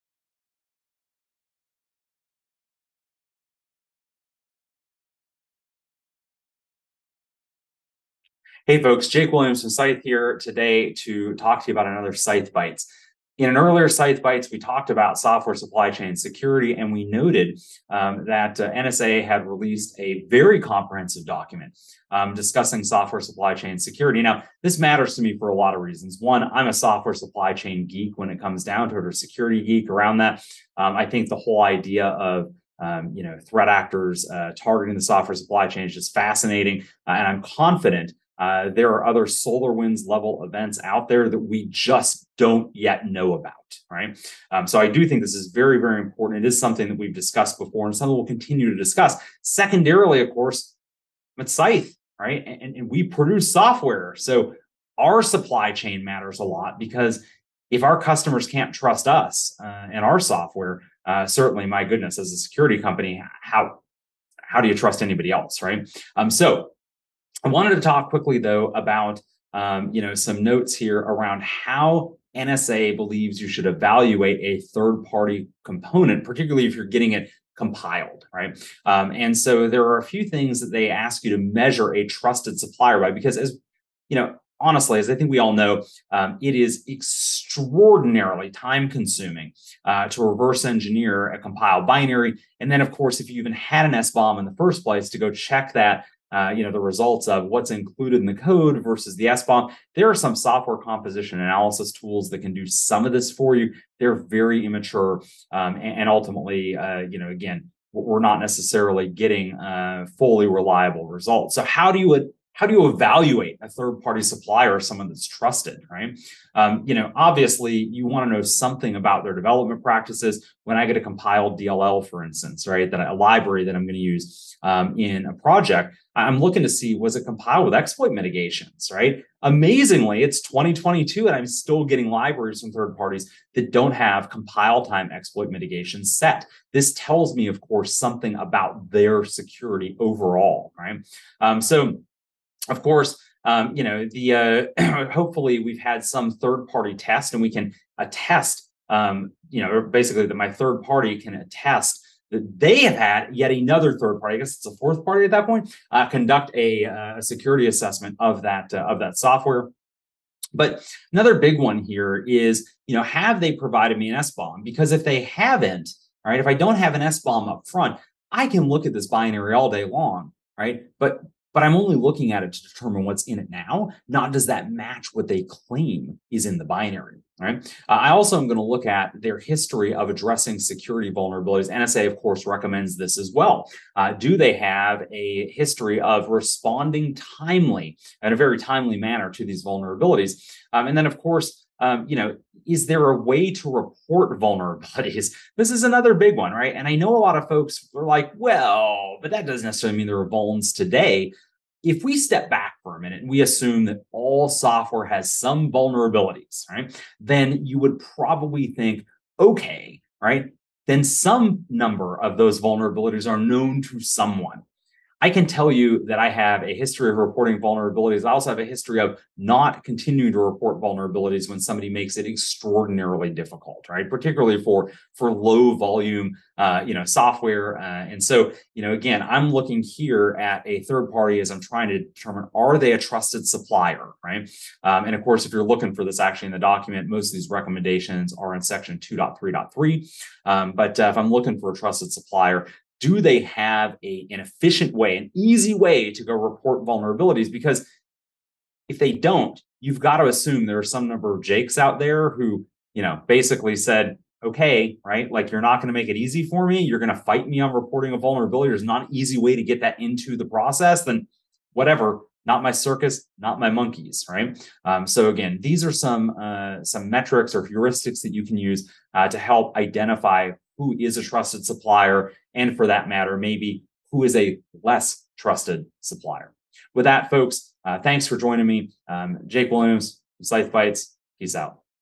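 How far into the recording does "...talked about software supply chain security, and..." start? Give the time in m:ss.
0:14.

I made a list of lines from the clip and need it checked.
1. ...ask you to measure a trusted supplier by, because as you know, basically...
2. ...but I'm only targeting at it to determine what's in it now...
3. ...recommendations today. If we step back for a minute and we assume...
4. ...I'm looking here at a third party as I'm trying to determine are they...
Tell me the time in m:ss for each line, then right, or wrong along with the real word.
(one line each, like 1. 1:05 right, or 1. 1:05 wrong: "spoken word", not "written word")
1. 1:20 wrong: "honestly", not "basically"
2. 2:51 wrong: "looking", not "targeting"
3. 3:20 wrong: "vulns", not "recommendations"
4. 3:49 right.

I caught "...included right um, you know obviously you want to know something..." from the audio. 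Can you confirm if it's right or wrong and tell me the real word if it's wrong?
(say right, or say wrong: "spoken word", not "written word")
wrong: "trusted", not "included".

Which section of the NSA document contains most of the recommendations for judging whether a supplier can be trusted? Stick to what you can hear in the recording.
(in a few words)
2.3.3.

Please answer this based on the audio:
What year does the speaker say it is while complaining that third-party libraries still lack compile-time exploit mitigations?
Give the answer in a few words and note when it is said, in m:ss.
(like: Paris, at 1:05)
2022, at 2:10.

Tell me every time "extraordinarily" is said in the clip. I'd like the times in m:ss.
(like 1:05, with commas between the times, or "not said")
1:26, 3:42.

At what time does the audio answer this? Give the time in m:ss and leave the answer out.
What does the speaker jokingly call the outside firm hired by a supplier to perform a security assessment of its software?
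2:34.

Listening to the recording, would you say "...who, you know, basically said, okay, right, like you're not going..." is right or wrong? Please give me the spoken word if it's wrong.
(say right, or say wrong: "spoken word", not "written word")
right.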